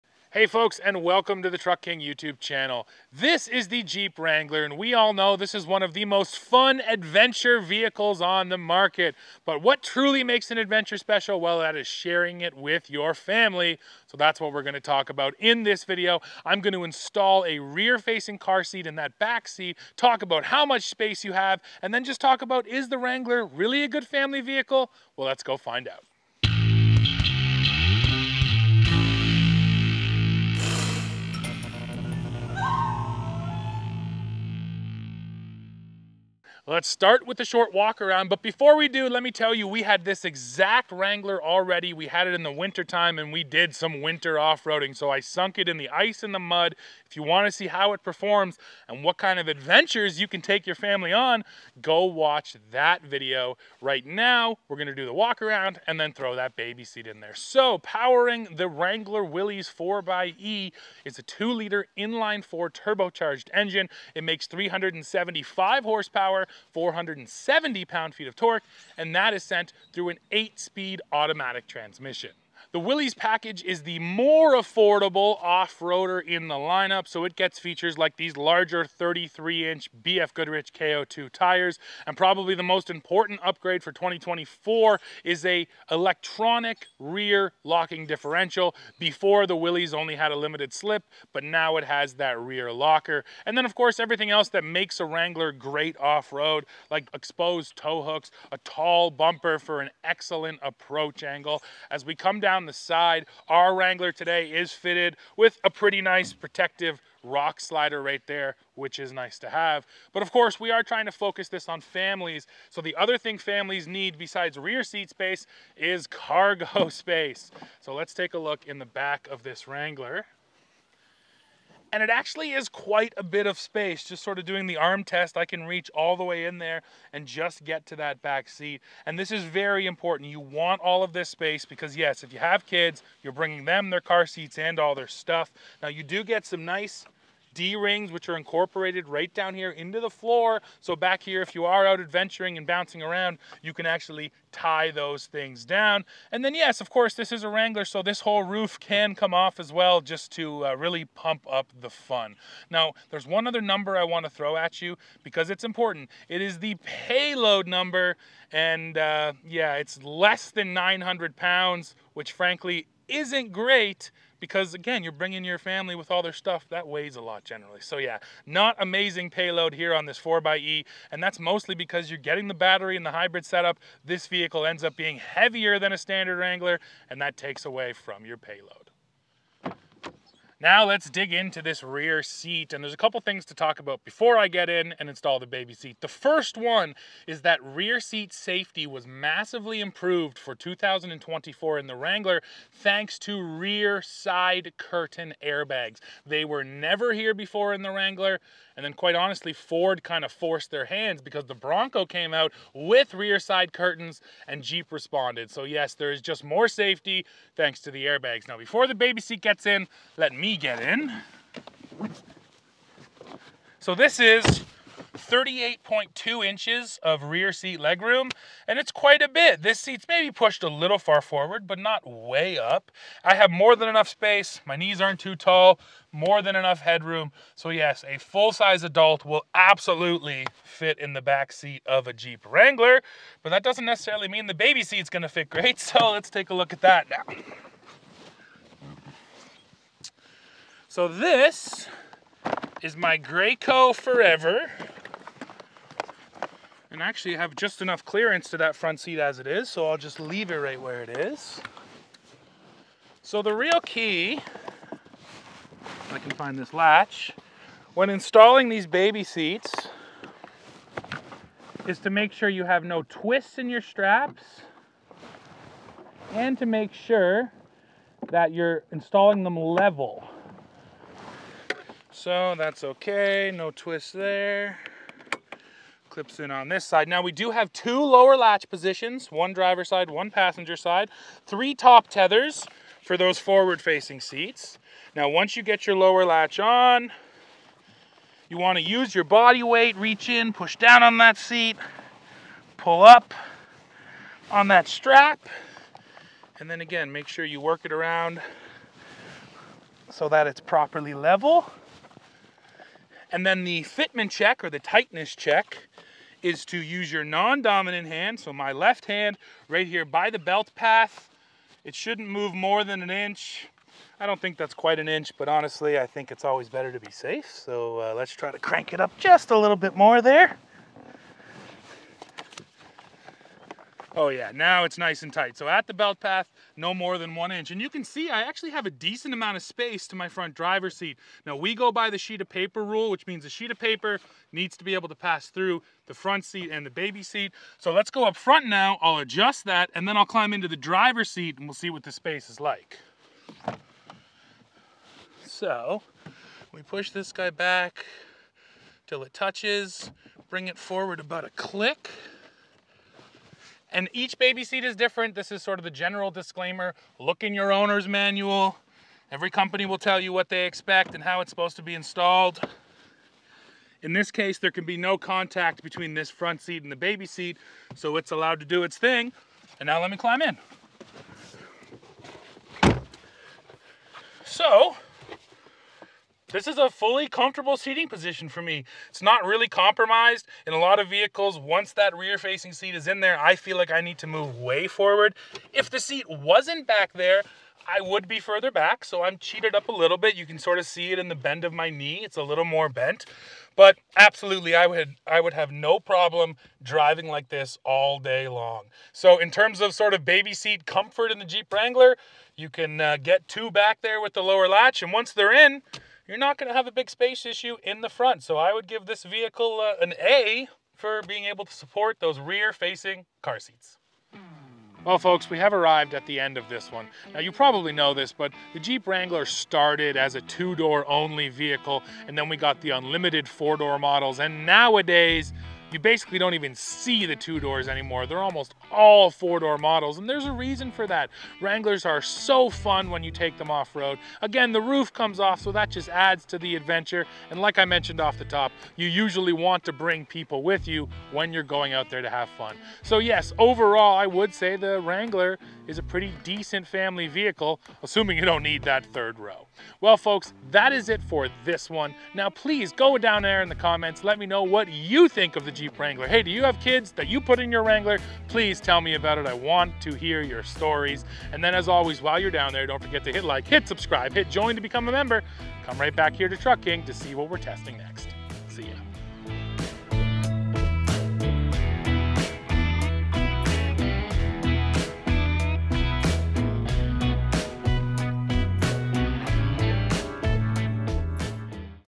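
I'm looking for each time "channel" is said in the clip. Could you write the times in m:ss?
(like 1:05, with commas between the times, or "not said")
0:02.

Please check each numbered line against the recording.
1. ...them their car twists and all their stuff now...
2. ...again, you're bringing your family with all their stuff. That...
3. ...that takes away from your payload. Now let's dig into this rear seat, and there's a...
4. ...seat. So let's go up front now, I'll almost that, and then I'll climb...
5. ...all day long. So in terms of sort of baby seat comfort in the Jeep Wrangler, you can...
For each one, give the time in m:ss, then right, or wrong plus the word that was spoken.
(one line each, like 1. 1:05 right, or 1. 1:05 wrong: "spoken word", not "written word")
1. 2:13 wrong: "seats", not "twists"
2. 2:44 right
3. 2:57 right
4. 5:37 wrong: "adjust", not "almost"
5. 6:37 right.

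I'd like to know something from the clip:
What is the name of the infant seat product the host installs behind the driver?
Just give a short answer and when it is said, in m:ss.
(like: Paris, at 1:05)
Graco Forever, at 4:03.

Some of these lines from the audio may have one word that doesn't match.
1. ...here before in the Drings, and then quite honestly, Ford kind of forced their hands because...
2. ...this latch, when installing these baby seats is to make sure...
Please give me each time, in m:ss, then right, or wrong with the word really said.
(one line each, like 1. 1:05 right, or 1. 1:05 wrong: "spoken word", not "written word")
1. 3:17 wrong: "Wrangler", not "Drings"
2. 4:16 right.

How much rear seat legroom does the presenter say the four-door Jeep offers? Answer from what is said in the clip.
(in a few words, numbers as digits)
38.2 inches.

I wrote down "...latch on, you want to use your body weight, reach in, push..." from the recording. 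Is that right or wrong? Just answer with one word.
right.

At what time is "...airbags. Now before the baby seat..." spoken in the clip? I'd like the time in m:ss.
3:28.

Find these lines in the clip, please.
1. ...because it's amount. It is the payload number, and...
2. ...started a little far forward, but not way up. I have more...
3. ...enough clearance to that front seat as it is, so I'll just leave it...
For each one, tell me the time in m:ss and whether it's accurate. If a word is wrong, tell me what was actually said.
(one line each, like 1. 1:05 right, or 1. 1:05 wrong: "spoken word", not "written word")
1. 2:35 wrong: "important", not "amount"
2. 3:40 wrong: "pushed", not "started"
3. 4:07 right.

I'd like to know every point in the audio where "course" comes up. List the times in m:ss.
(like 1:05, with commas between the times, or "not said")
1:33, 1:50, 2:26.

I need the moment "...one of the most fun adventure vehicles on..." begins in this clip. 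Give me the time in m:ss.
0:05.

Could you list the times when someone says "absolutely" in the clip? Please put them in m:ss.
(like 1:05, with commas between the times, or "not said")
3:49, 6:34.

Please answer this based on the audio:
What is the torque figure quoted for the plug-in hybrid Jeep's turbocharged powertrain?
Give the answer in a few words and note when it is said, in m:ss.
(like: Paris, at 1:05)
470 pound-feet, at 1:06.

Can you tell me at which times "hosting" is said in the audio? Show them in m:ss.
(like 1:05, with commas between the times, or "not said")
not said.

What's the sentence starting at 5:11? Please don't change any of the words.
It shouldn't move more than an inch.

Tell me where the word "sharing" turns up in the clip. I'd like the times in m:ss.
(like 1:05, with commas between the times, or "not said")
0:11.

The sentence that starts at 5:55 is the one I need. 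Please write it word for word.
This is sort of the general disclaimer.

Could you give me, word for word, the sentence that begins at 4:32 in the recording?
So that's okay, no twist there.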